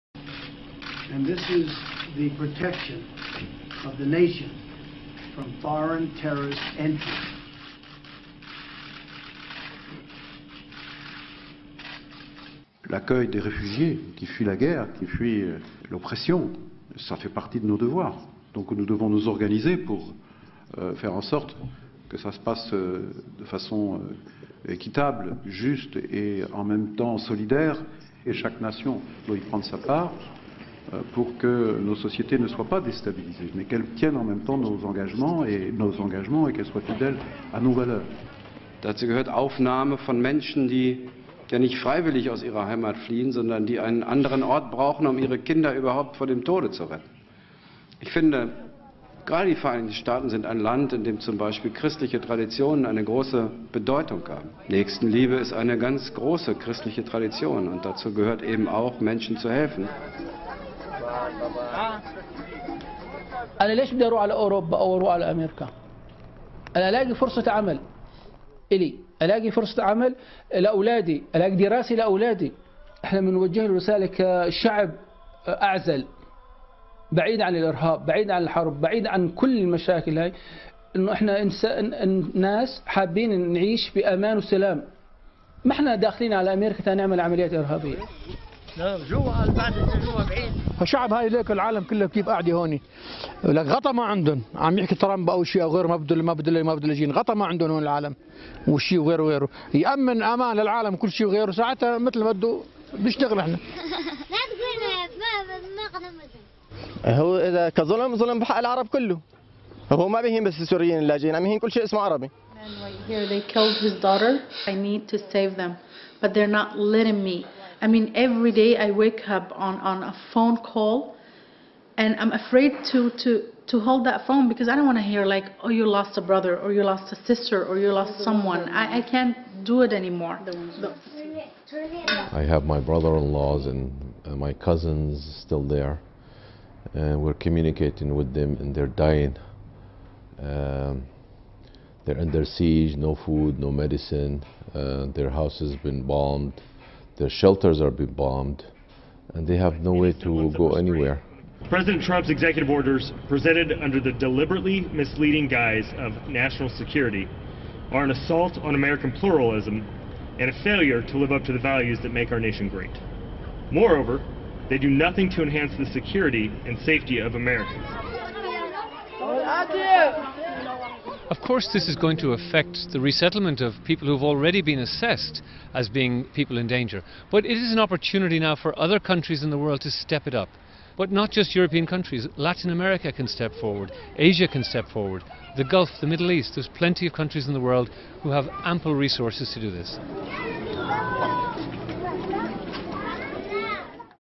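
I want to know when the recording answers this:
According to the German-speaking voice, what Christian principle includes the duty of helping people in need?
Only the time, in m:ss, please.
0:54.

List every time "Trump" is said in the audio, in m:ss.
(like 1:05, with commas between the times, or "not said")
2:32.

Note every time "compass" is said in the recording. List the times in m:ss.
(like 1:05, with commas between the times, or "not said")
not said.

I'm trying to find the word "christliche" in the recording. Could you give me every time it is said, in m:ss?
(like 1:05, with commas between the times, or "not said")
0:51, 0:56.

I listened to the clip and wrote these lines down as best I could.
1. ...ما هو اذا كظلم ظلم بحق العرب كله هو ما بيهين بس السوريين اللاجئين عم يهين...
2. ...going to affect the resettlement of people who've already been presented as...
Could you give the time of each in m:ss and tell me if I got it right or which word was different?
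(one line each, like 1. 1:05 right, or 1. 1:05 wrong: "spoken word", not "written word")
1. 1:47 right
2. 2:51 wrong: "assessed", not "presented".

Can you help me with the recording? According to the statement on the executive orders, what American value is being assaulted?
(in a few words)
pluralism.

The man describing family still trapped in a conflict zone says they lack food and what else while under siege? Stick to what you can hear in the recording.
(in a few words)
medicine.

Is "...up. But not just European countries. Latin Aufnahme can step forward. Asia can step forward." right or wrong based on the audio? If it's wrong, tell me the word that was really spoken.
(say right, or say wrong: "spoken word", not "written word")
wrong: "America", not "Aufnahme".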